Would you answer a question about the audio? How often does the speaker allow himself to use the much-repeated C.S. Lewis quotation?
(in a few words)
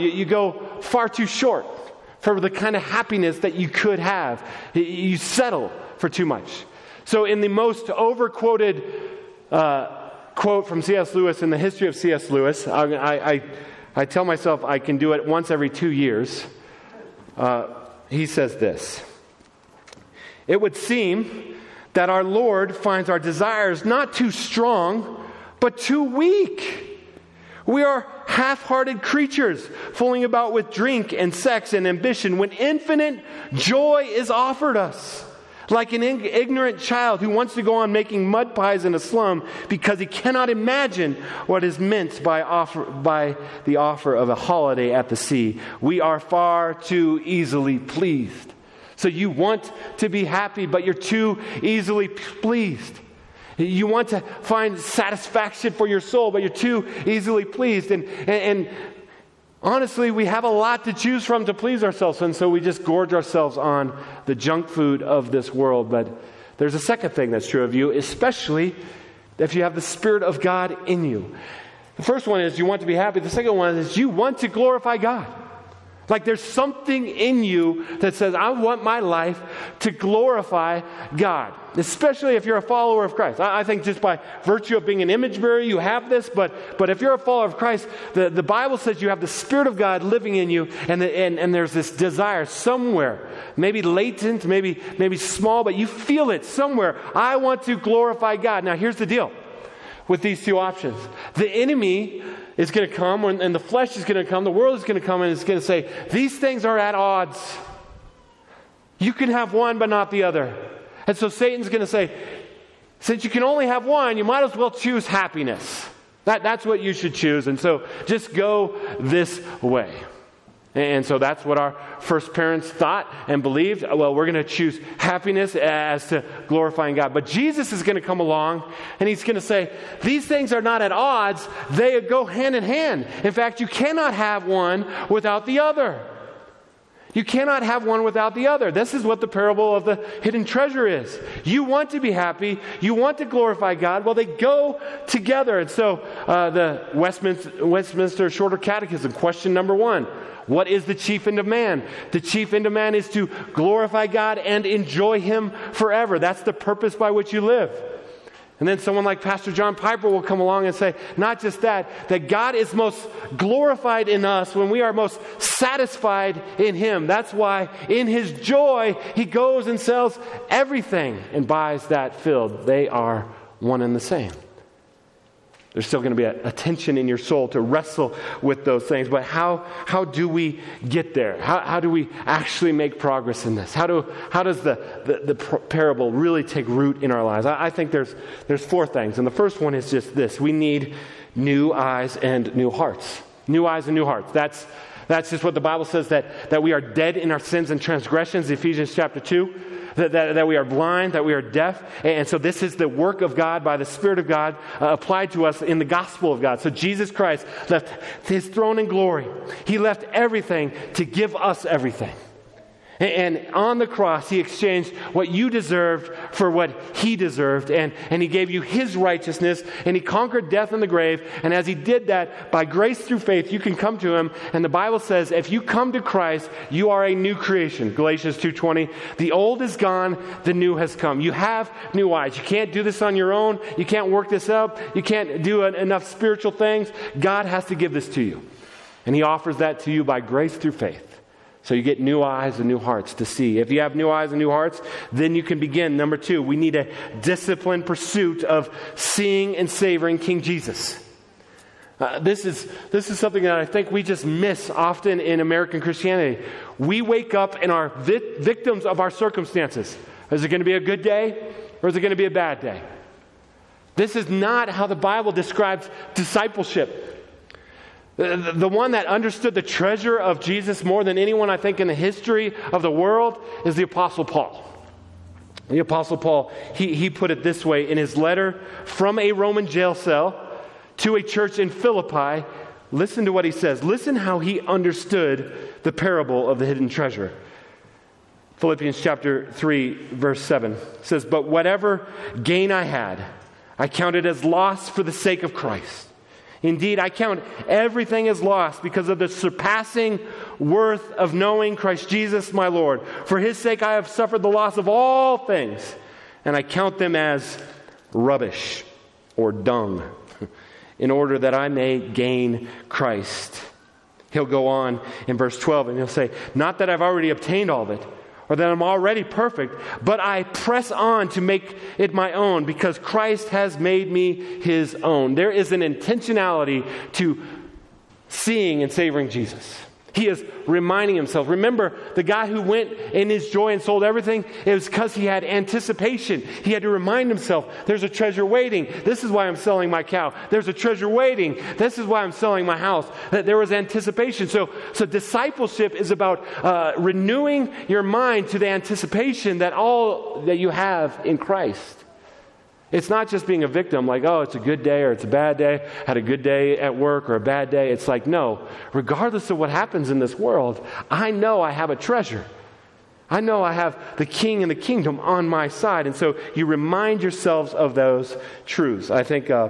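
Once every two years.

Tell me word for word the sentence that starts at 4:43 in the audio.
Listen how he understood the parable of the hidden treasure.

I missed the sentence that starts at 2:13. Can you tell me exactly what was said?
In fact, you cannot have one without the other.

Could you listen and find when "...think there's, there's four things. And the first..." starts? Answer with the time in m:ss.
3:07.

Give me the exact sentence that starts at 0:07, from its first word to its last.
So, in the most overquoted uh, quote from C.S.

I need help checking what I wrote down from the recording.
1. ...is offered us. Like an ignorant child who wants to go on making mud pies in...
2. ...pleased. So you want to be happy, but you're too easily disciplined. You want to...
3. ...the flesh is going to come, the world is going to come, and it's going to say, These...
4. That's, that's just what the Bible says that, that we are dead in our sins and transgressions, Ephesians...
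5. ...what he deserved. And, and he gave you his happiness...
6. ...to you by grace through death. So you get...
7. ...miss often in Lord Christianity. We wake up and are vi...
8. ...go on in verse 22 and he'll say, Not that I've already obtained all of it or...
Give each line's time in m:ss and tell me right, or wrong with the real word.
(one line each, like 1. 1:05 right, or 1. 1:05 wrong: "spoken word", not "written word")
1. 0:34 right
2. 0:47 wrong: "pleased", not "disciplined"
3. 1:43 right
4. 3:14 right
5. 3:36 wrong: "righteousness", not "happiness"
6. 3:59 wrong: "faith", not "death"
7. 4:14 wrong: "American", not "Lord"
8. 5:14 wrong: "12", not "22".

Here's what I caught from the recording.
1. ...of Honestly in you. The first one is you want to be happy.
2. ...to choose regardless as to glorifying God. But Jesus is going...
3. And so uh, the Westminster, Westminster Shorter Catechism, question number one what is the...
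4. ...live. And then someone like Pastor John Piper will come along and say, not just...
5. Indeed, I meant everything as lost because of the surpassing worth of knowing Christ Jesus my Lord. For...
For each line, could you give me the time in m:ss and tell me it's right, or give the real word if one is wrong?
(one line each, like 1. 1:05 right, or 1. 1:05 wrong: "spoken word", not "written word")
1. 1:10 wrong: "God", not "Honestly"
2. 2:04 wrong: "happiness", not "regardless"
3. 2:25 right
4. 2:37 right
5. 4:56 wrong: "count", not "meant".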